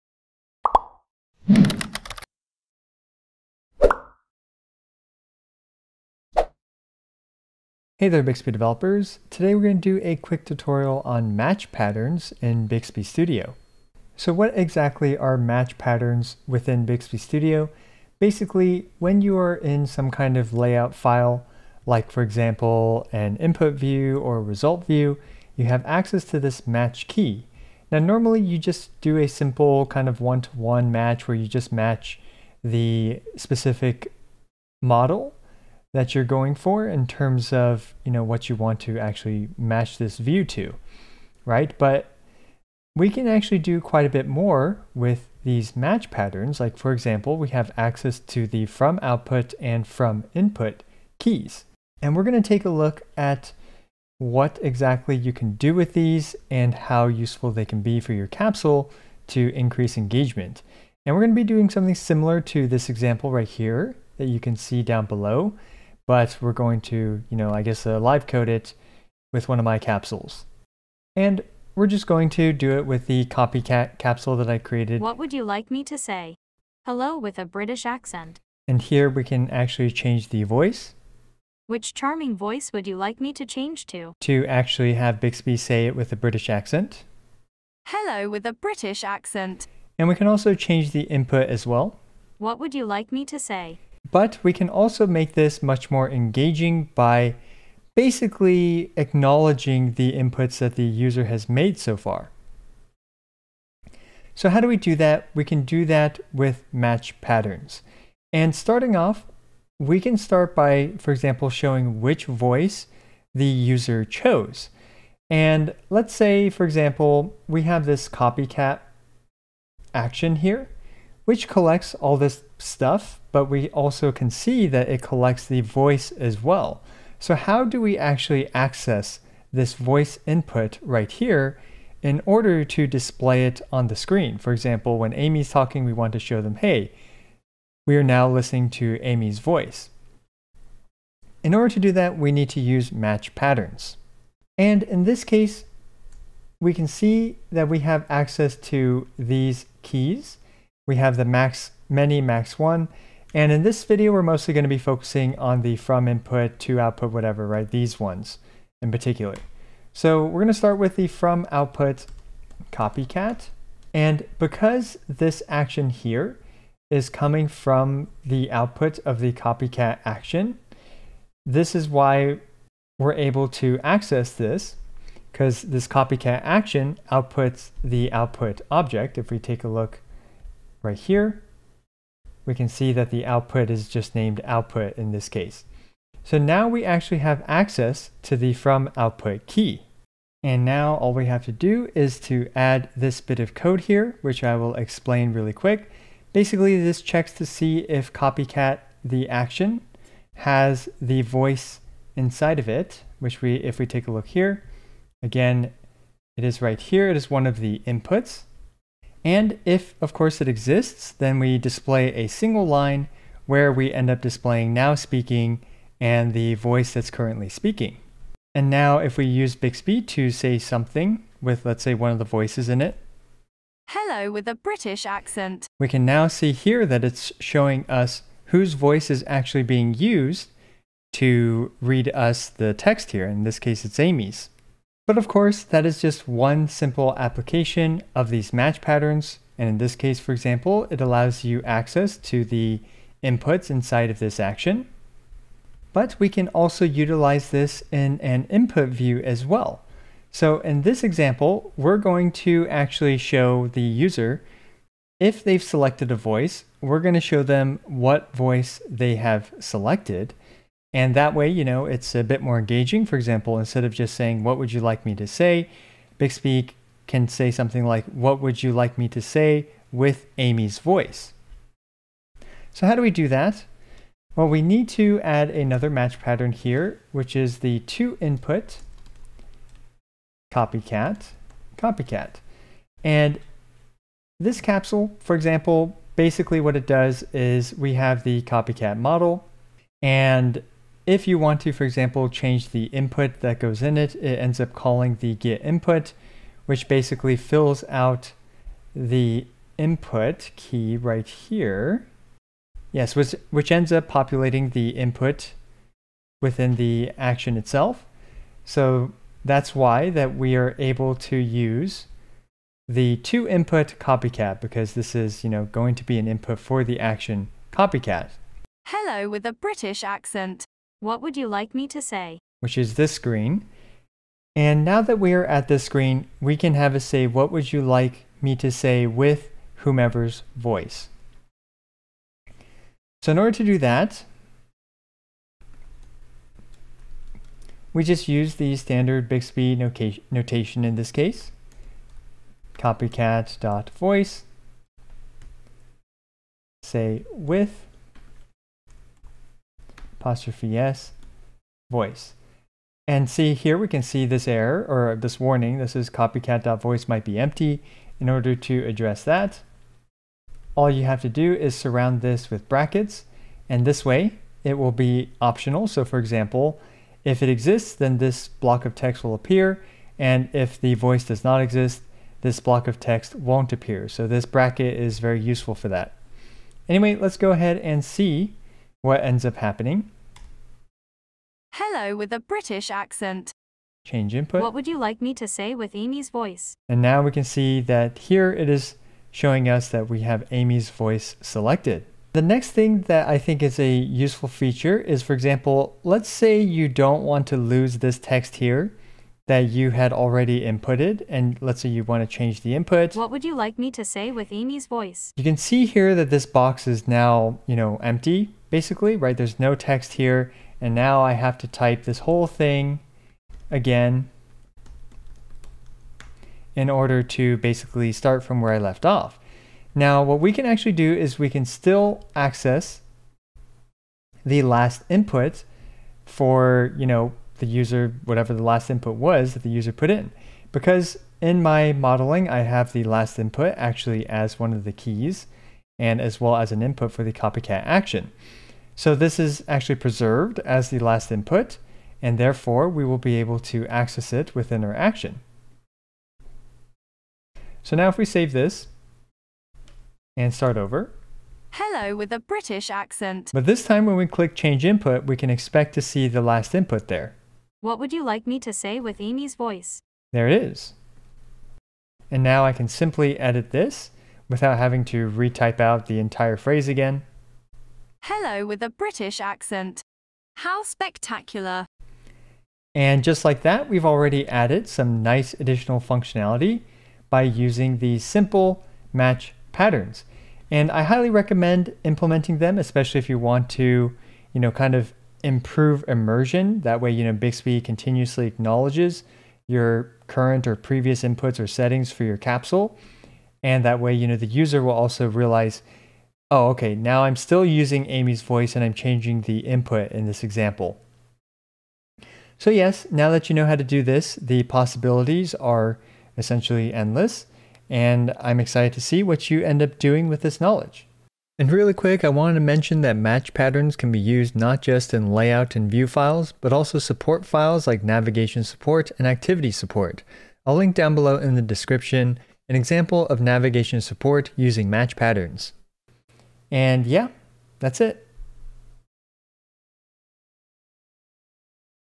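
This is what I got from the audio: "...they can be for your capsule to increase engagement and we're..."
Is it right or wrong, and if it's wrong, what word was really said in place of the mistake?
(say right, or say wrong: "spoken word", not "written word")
right.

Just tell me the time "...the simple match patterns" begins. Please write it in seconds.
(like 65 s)
477 s.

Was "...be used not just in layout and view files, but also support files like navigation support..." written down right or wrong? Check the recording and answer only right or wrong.
right.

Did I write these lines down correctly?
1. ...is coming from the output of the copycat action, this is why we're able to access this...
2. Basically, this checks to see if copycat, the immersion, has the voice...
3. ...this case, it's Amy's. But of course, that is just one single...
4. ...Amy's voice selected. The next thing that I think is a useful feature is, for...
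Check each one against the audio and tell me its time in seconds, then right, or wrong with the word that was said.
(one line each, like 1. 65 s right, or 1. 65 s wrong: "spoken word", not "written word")
1. 166 s right
2. 196 s wrong: "action", not "immersion"
3. 233 s wrong: "simple", not "single"
4. 390 s right.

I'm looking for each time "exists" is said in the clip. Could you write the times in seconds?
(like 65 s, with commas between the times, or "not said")
210 s, 367 s, 371 s.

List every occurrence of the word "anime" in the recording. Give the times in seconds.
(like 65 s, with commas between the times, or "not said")
not said.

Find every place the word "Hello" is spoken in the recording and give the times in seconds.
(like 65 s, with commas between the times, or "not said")
76 s, 87 s, 223 s, 318 s, 381 s, 451 s, 468 s.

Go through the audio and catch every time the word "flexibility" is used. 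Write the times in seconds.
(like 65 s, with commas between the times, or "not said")
not said.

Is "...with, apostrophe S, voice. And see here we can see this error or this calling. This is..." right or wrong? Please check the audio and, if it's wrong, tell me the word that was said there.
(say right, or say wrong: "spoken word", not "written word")
wrong: "warning", not "calling".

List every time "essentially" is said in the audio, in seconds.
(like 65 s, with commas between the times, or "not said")
506 s.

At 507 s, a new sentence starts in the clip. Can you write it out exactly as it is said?
And I'm excited to see what you end up doing with this knowledge.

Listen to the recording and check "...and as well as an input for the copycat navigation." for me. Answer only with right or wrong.
wrong.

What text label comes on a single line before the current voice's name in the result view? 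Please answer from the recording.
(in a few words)
now speaking.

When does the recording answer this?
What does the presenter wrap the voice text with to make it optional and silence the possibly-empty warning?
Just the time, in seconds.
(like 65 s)
362 s.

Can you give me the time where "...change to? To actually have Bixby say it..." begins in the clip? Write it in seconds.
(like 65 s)
83 s.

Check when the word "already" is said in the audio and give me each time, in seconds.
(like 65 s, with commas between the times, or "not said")
400 s, 474 s.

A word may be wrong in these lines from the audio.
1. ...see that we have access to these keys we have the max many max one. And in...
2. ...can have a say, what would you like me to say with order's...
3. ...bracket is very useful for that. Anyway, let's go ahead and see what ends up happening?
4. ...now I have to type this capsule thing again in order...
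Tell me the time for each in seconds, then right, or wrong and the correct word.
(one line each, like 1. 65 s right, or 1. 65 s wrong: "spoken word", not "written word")
1. 146 s right
2. 326 s wrong: "whomever", not "order"
3. 374 s right
4. 410 s wrong: "whole", not "capsule".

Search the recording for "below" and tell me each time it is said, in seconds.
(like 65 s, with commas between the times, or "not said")
65 s, 521 s.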